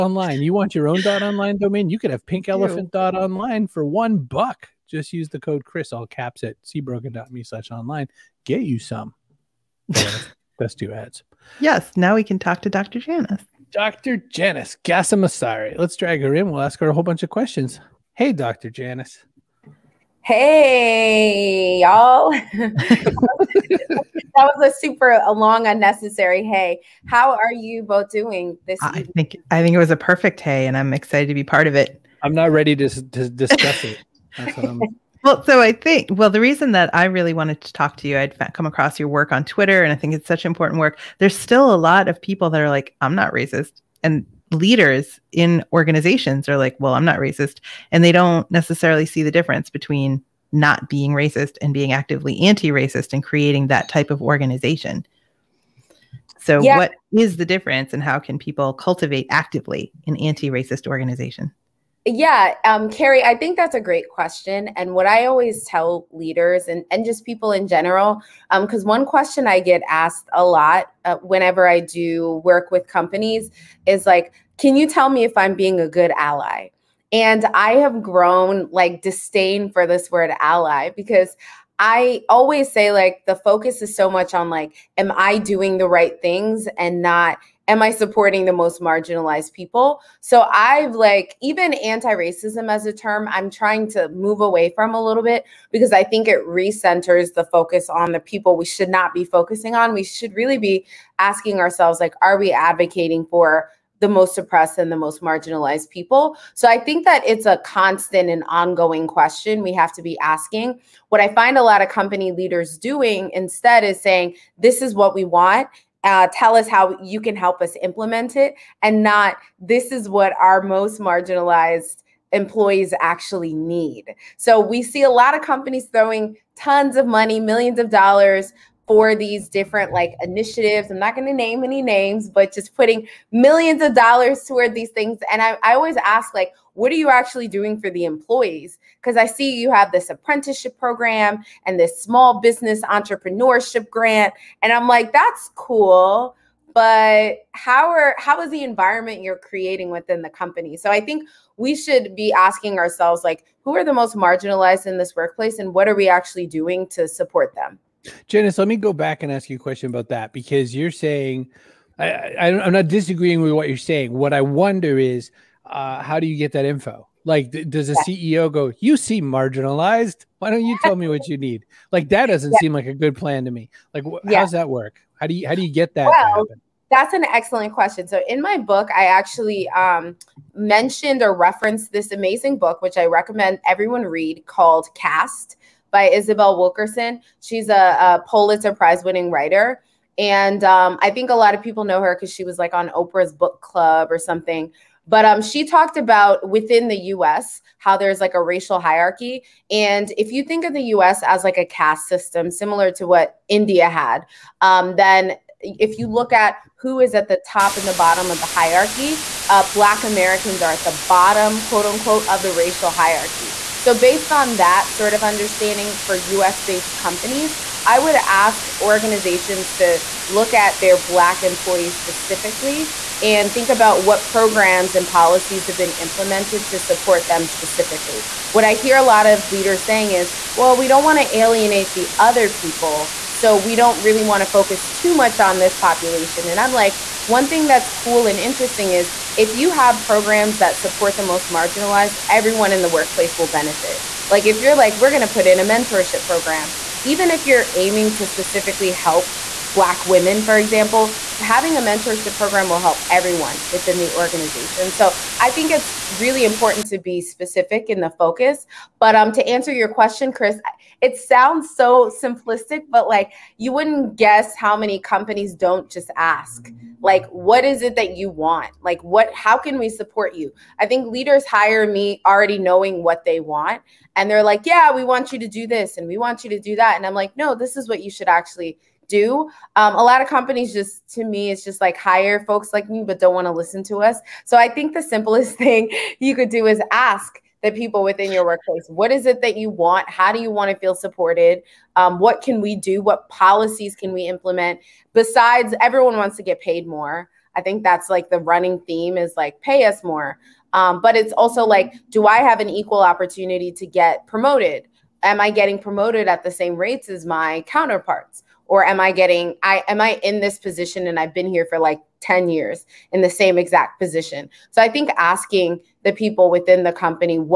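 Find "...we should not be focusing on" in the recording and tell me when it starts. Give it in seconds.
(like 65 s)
98 s.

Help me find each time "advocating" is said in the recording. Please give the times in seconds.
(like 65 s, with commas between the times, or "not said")
102 s.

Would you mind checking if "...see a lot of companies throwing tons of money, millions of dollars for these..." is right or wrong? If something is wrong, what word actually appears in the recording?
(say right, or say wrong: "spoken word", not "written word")
right.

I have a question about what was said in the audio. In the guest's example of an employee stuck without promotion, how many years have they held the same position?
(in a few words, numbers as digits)
10.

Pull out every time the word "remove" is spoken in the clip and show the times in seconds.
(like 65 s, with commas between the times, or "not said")
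not said.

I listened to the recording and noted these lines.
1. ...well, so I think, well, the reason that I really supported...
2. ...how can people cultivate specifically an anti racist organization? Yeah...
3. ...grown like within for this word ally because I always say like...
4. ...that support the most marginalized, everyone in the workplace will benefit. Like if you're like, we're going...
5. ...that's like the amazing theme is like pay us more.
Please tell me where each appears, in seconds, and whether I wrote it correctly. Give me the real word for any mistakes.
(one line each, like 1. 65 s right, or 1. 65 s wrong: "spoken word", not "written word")
1. 35 s wrong: "wanted", not "supported"
2. 58 s wrong: "actively", not "specifically"
3. 78 s wrong: "disdain", not "within"
4. 240 s right
5. 297 s wrong: "running", not "amazing".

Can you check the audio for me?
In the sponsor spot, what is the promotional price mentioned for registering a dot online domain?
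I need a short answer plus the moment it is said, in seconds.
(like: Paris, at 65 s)
1 buck, at 3 s.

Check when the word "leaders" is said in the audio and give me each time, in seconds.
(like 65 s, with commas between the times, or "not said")
44 s, 66 s, 112 s, 229 s, 271 s.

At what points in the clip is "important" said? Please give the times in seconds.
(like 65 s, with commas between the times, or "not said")
40 s, 256 s.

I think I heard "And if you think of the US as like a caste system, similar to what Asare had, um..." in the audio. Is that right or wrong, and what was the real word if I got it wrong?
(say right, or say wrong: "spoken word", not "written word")
wrong: "India", not "Asare".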